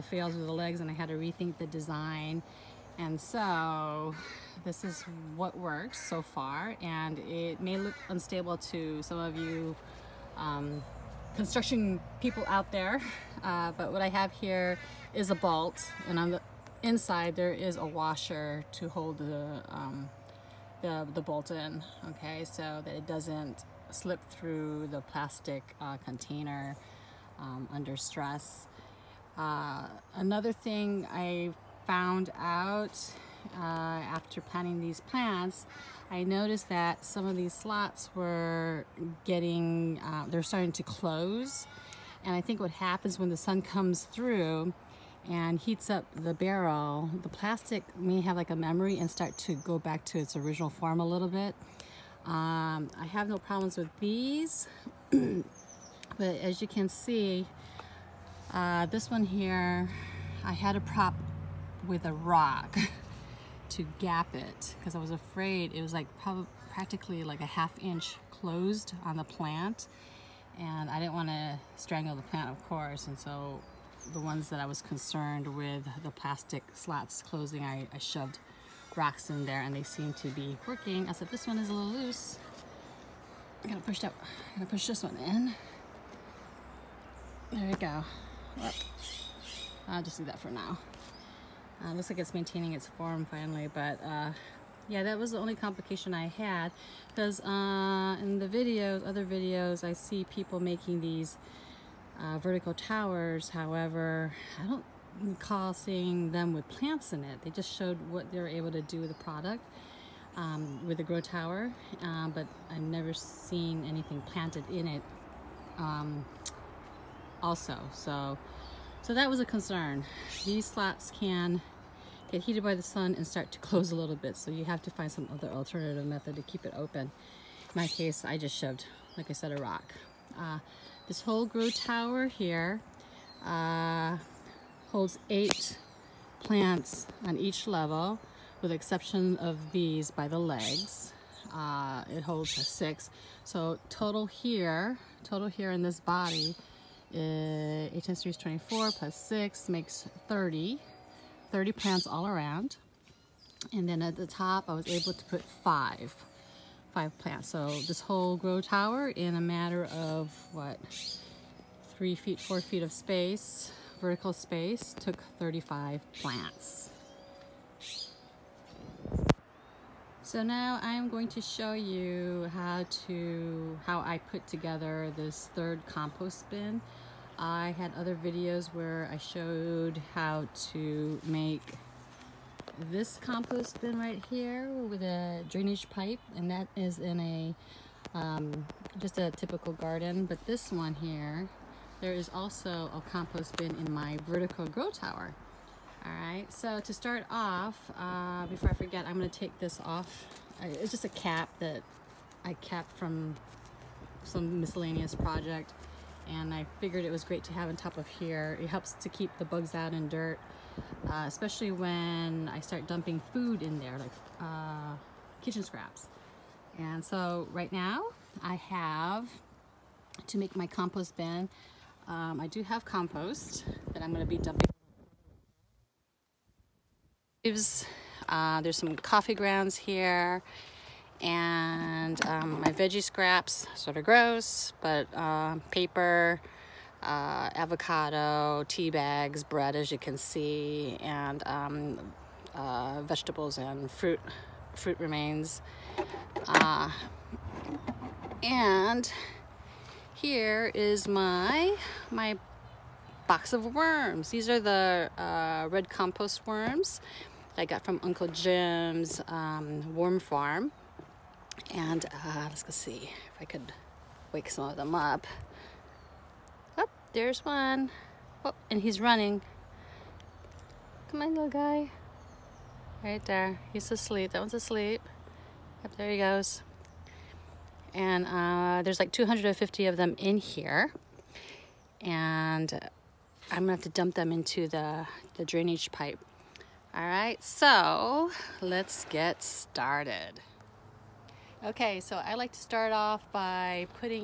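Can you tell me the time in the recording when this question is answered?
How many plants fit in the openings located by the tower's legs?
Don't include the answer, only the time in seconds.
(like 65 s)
142 s.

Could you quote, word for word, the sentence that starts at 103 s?
However, I don't recall seeing them with plants in it.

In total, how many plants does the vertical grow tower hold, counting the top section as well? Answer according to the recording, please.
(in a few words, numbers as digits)
35.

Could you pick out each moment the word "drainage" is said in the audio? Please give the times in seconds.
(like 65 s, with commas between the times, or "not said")
185 s, 285 s.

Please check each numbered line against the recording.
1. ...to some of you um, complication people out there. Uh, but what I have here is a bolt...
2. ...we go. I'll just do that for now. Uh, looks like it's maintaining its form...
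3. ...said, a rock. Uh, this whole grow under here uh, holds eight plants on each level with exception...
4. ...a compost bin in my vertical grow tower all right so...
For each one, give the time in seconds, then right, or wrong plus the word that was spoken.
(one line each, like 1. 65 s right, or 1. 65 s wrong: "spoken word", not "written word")
1. 8 s wrong: "construction", not "complication"
2. 87 s right
3. 129 s wrong: "tower", not "under"
4. 192 s right.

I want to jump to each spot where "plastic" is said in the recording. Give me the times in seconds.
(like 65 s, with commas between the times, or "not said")
25 s, 47 s, 76 s.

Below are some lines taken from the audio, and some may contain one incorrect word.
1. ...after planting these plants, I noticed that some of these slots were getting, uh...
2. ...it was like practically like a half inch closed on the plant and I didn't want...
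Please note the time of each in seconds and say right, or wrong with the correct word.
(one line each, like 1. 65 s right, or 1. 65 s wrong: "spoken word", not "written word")
1. 33 s right
2. 65 s right.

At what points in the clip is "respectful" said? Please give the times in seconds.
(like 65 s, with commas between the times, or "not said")
not said.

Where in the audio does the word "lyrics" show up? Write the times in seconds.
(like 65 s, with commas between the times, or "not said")
not said.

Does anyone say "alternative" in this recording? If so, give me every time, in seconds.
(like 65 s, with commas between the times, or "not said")
125 s.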